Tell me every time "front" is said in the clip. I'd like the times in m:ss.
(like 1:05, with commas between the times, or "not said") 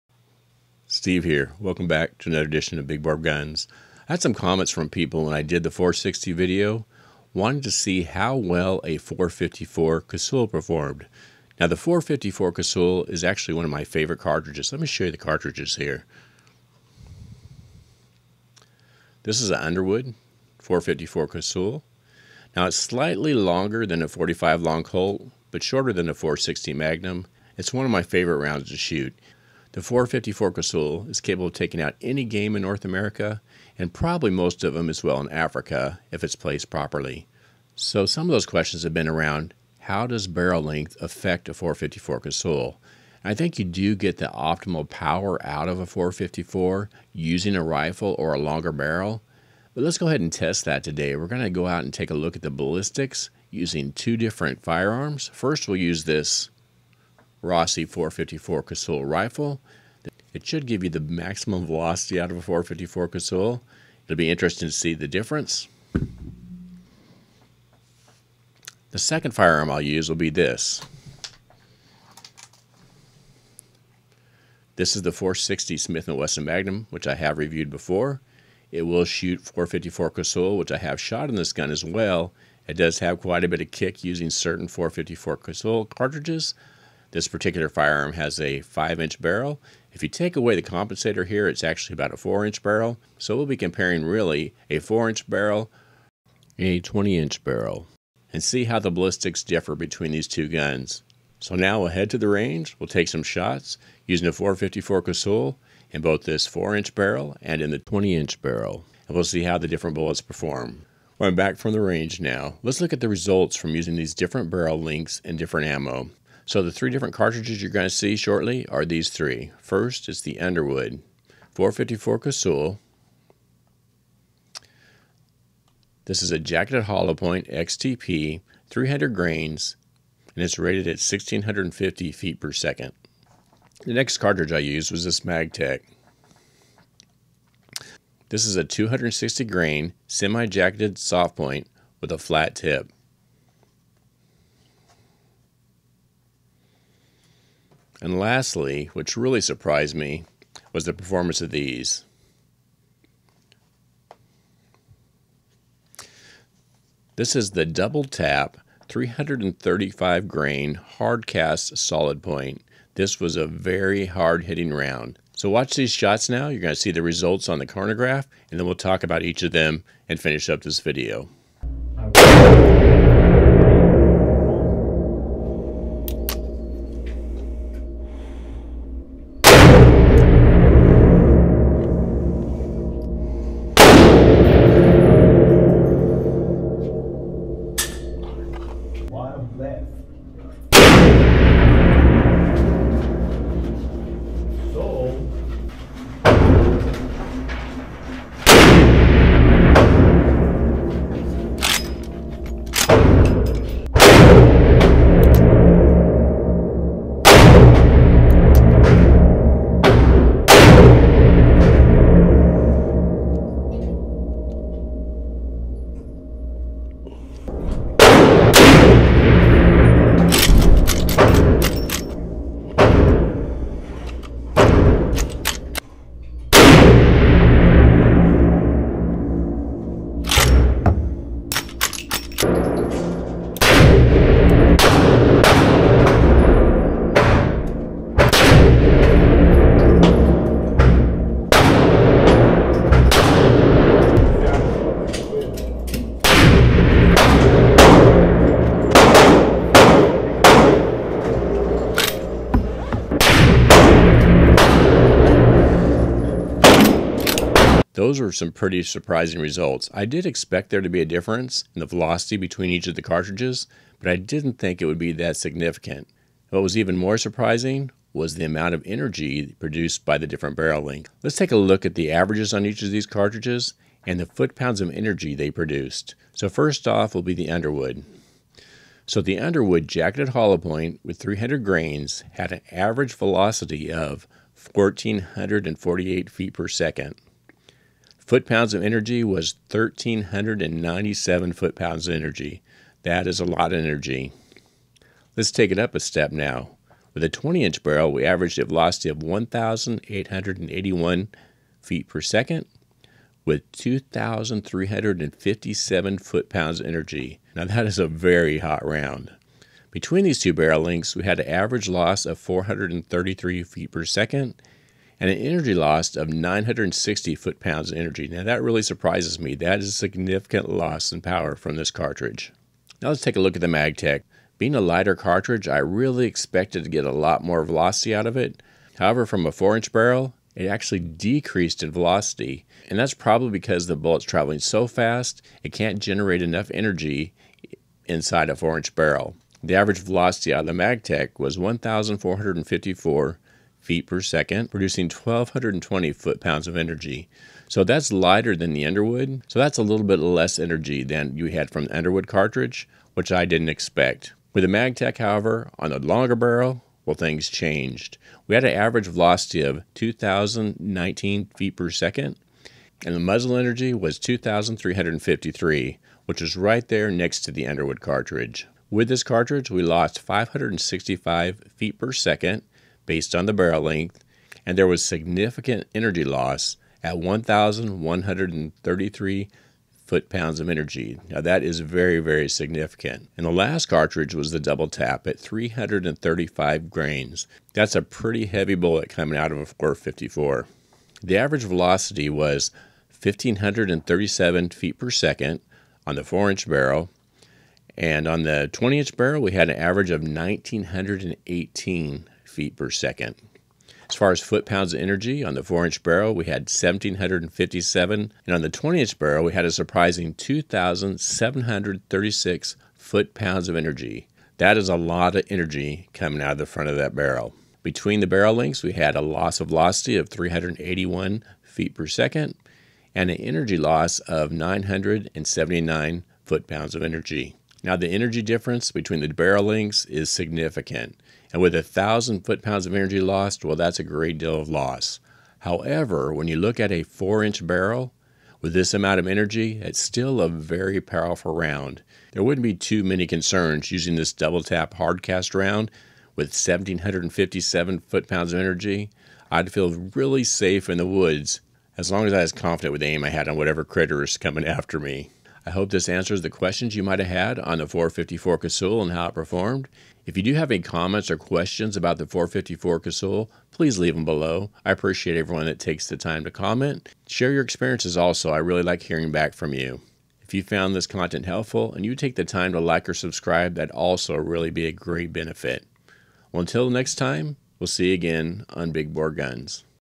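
6:56.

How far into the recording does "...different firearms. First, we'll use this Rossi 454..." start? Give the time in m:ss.
0:54.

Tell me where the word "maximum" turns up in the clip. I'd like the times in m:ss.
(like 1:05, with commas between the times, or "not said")
1:00.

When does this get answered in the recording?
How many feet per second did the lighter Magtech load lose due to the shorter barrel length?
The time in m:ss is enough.
6:10.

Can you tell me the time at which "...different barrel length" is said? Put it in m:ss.
4:30.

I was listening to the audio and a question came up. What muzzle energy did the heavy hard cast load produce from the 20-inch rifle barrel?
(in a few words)
2,736 foot-pounds.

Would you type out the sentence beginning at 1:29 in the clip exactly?
If you take away the compensator here, it's actually about a 4-inch barrel.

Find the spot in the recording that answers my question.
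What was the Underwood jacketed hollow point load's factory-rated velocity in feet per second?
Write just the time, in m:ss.
2:10.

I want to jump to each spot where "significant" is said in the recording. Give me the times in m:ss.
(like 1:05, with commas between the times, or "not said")
4:25, 5:19, 6:15, 6:22, 7:10.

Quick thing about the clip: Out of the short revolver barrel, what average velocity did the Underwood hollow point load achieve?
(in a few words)
1,448 feet per second.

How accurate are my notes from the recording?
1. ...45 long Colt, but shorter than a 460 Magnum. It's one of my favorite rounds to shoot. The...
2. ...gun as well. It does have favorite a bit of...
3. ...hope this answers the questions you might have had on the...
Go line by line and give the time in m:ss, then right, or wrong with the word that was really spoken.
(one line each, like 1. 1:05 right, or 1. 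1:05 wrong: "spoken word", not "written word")
1. 0:24 right
2. 1:21 wrong: "quite", not "favorite"
3. 7:35 right.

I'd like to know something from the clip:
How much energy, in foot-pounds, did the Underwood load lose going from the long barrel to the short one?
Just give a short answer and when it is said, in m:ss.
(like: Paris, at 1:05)
960 foot-pounds, at 5:16.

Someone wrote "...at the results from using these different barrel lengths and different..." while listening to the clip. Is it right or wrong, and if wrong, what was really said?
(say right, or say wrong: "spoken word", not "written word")
right.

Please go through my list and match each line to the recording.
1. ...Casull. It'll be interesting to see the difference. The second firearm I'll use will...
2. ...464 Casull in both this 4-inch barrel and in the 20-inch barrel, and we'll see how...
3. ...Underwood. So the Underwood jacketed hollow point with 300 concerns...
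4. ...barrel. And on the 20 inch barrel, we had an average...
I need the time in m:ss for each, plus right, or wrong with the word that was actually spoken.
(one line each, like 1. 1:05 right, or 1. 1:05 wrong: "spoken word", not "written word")
1. 1:03 right
2. 1:44 wrong: "454", not "464"
3. 4:37 wrong: "grains", not "concerns"
4. 6:36 right.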